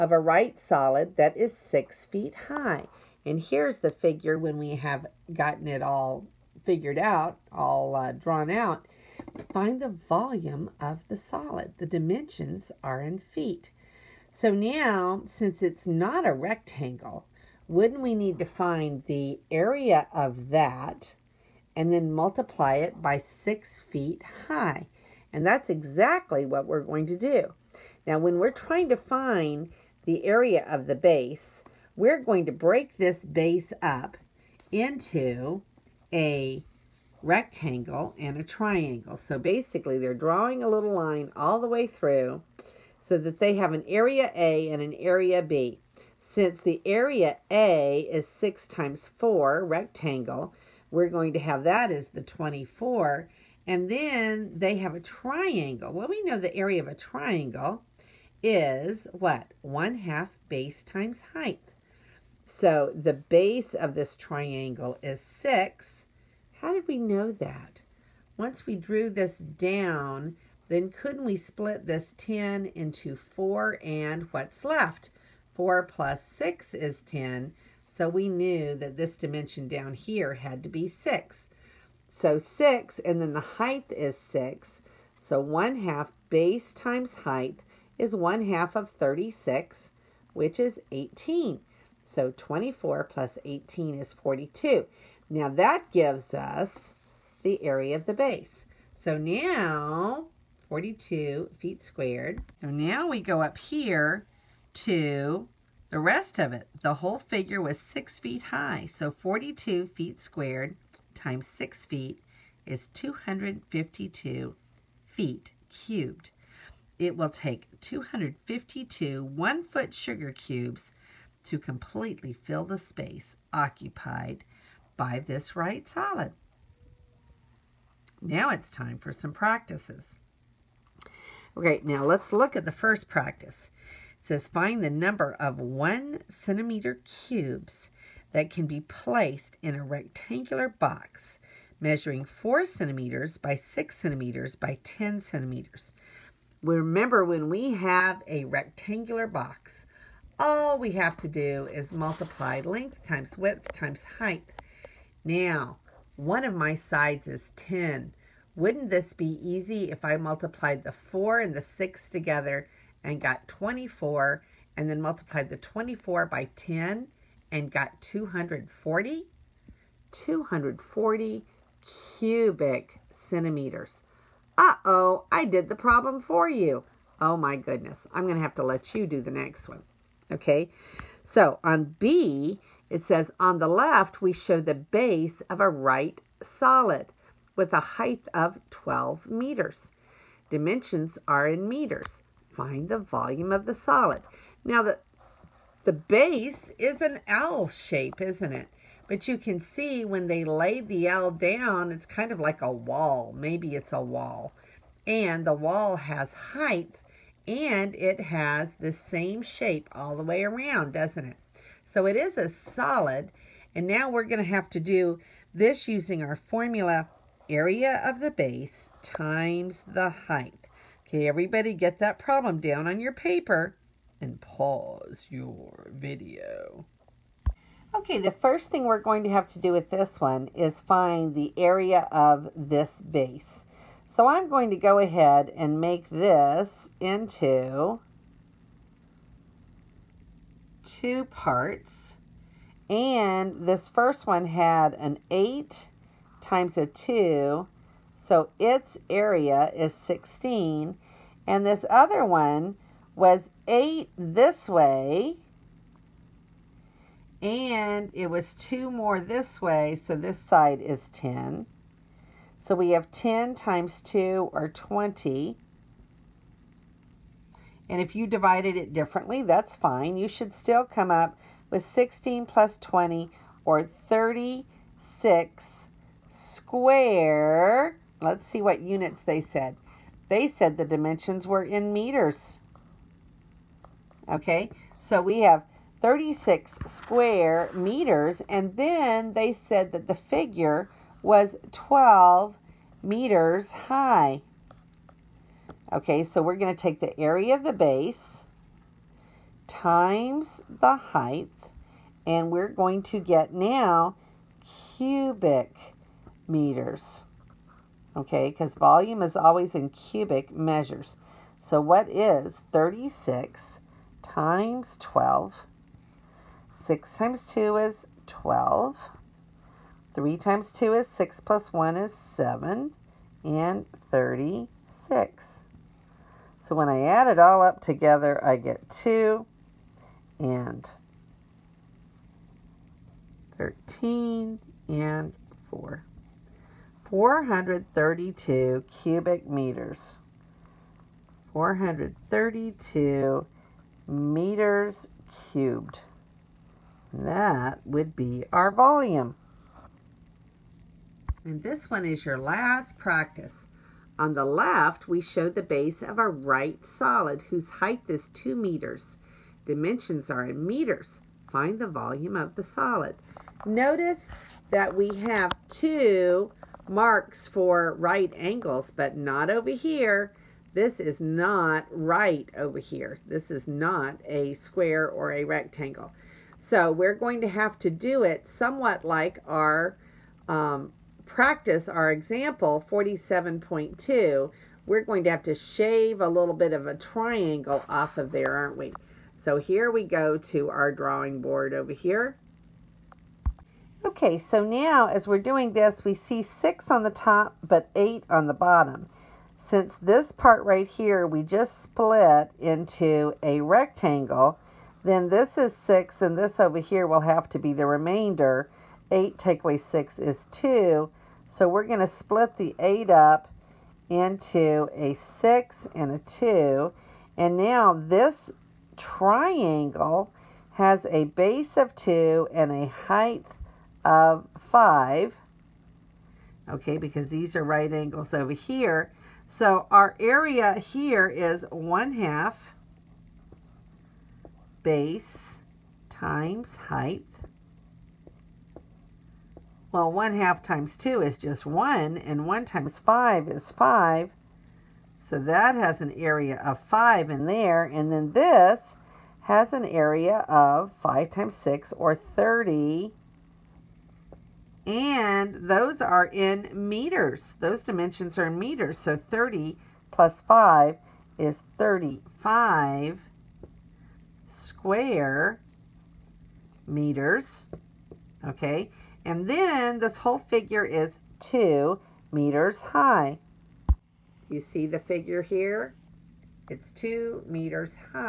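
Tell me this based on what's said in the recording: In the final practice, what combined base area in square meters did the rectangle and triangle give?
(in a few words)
35.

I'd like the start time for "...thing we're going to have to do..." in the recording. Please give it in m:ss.
3:48.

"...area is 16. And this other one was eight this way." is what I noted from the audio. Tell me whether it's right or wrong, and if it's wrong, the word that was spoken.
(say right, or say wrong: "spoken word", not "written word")
right.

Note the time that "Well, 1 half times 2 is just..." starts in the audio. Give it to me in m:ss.
7:19.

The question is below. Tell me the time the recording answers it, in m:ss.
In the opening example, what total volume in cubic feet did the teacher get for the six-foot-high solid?
1:52.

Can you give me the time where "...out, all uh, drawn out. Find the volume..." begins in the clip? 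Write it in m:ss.
0:06.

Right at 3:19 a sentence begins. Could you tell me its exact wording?
But you can see when they laid the L down, it's kind of like a wall.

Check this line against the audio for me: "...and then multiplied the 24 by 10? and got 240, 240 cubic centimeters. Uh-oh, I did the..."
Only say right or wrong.
right.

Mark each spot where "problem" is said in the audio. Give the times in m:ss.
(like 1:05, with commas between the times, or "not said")
2:55, 3:42.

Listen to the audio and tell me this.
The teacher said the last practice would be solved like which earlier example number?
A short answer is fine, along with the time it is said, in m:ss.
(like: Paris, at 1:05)
47.2, at 6:22.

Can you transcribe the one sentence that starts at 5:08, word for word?
Okay, because volume is always in cubic measures.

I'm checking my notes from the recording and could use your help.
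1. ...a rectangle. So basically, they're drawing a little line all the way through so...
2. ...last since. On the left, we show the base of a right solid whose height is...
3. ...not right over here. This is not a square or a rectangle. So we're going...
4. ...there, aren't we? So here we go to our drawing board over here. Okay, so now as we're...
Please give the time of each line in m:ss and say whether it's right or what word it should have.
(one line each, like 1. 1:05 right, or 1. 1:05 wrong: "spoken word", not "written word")
1. 0:38 wrong: "triangle", not "rectangle"
2. 5:52 wrong: "practice", not "since"
3. 6:11 right
4. 6:28 right.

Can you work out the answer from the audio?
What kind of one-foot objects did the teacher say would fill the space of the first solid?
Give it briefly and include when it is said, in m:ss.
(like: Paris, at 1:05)
sugar cubes, at 1:59.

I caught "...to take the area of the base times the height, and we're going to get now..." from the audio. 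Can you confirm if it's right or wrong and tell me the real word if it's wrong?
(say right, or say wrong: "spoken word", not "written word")
right.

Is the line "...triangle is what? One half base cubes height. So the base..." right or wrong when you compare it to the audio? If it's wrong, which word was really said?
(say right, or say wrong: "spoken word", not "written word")
wrong: "times", not "cubes".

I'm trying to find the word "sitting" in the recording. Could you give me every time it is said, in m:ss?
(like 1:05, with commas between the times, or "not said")
not said.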